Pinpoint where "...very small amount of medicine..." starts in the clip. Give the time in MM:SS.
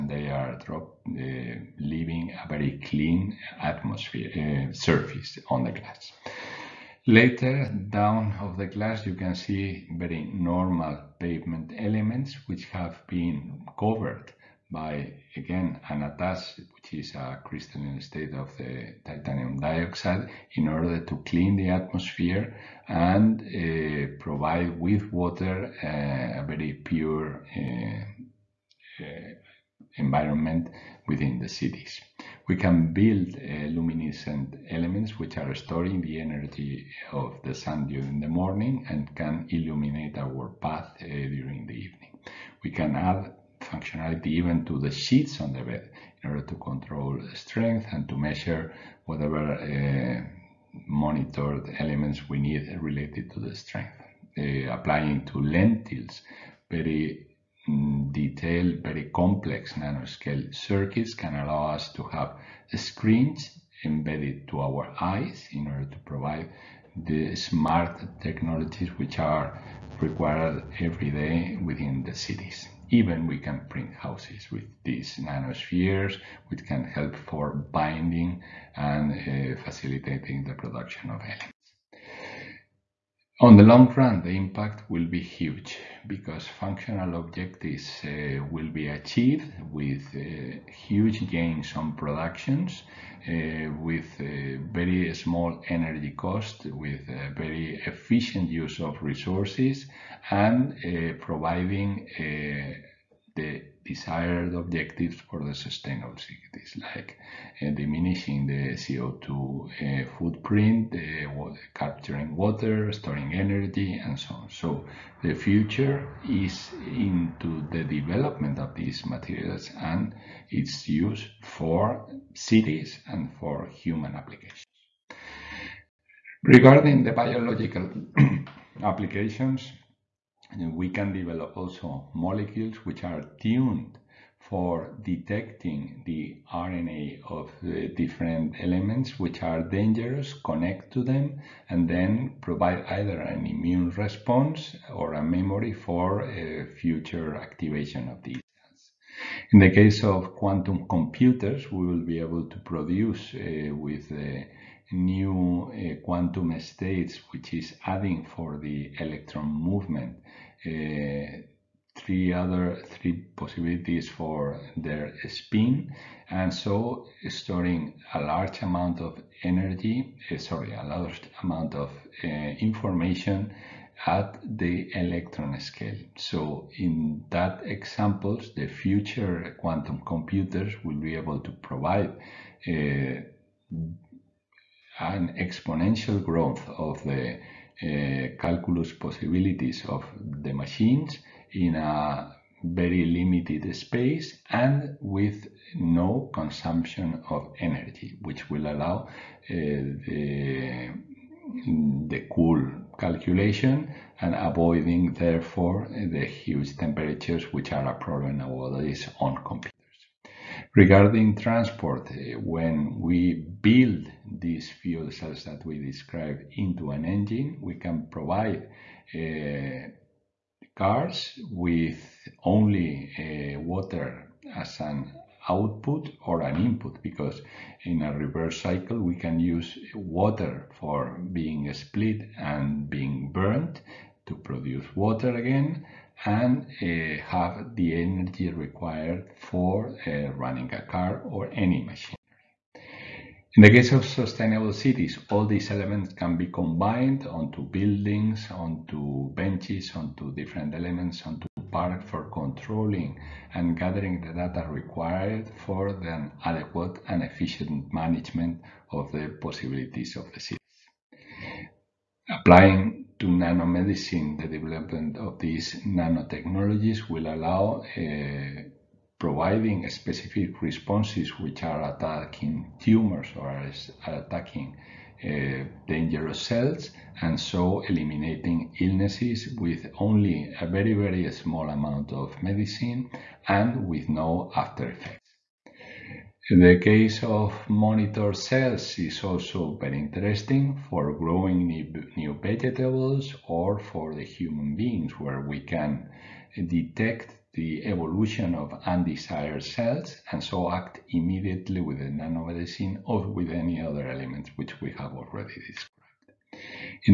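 04:40.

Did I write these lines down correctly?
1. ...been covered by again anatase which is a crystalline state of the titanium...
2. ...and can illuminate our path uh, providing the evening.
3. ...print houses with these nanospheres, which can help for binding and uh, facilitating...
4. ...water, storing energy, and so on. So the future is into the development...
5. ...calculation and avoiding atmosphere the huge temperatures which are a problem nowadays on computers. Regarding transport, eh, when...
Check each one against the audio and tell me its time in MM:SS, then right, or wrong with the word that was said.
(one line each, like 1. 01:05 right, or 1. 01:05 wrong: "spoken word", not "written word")
1. 00:13 right
2. 00:38 wrong: "during", not "providing"
3. 01:13 right
4. 01:52 right
5. 03:22 wrong: "therefore", not "atmosphere".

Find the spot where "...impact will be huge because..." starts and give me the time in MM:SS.
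01:24.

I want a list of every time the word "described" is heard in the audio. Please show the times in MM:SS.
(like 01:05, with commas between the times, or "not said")
03:35, 05:05.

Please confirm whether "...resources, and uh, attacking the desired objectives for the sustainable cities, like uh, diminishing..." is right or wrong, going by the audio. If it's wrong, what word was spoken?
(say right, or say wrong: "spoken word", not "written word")
wrong: "providing", not "attacking".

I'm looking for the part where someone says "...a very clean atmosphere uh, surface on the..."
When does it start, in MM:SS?
00:02.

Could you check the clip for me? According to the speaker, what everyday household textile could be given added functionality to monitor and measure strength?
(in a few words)
sheets on the bed.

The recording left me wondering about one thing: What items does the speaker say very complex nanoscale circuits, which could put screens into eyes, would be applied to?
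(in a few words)
lentils.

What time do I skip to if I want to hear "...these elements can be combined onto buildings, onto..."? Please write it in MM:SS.
04:05.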